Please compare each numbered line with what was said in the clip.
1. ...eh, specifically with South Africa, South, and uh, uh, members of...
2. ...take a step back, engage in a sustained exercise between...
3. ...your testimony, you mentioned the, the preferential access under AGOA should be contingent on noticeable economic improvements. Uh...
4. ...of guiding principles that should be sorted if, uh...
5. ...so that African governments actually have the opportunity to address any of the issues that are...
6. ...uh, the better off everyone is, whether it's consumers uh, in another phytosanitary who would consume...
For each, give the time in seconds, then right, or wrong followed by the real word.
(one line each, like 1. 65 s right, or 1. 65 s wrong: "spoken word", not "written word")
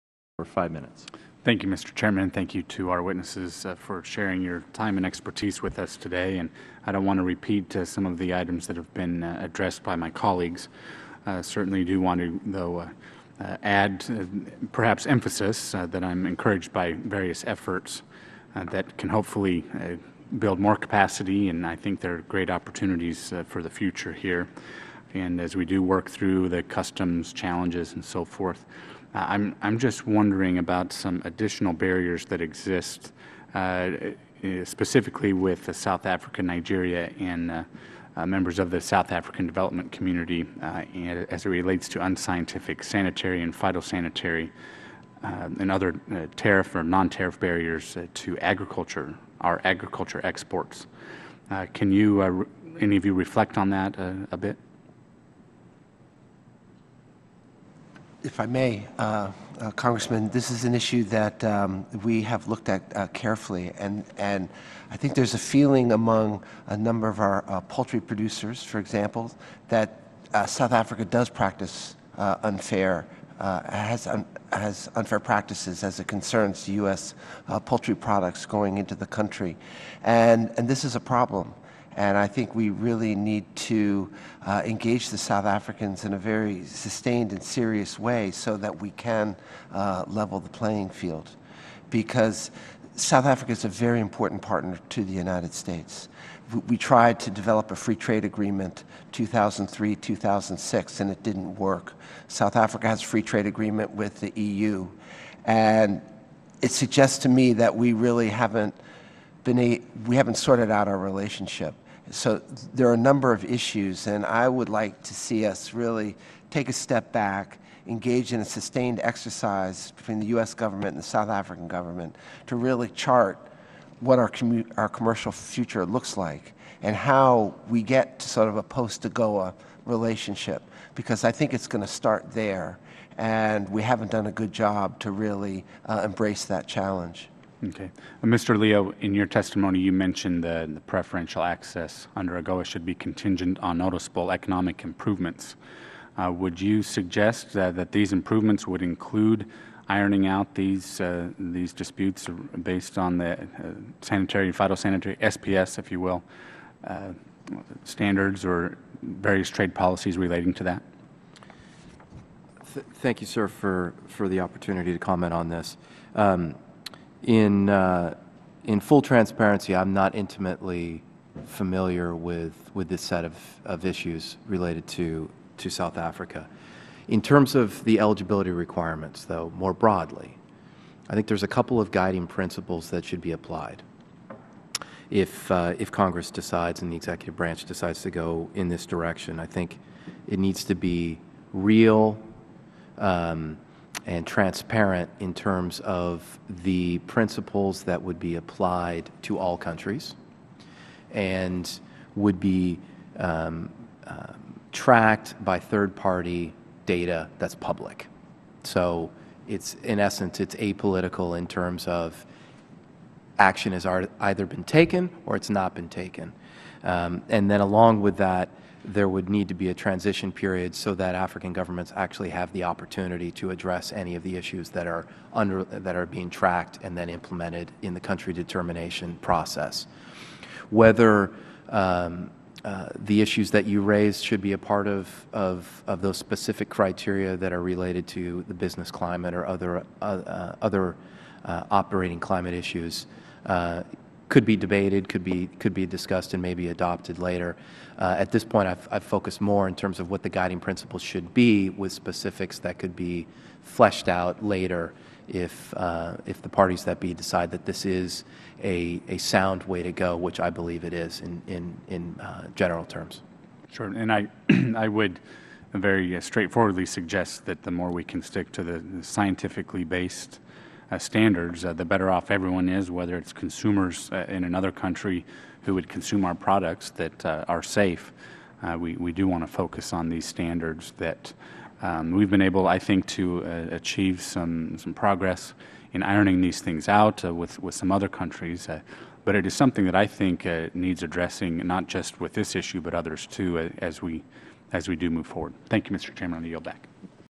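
1. 34 s wrong: "Nigeria", not "South"
2. 116 s right
3. 139 s right
4. 181 s wrong: "applied", not "sorted"
5. 220 s right
6. 271 s wrong: "country", not "phytosanitary".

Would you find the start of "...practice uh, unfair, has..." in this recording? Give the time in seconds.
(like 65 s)
71 s.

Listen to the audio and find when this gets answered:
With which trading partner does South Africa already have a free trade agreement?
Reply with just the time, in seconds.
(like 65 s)
104 s.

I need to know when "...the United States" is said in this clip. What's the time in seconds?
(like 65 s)
95 s.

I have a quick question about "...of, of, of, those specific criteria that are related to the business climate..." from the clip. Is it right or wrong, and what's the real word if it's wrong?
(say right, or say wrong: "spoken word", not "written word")
right.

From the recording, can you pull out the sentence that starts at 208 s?
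So it's, in essence, it's apolitical in terms of action has either been taken or it's not been taken.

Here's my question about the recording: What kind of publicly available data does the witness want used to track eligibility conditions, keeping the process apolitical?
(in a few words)
third party data.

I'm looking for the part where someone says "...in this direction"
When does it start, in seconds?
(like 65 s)
188 s.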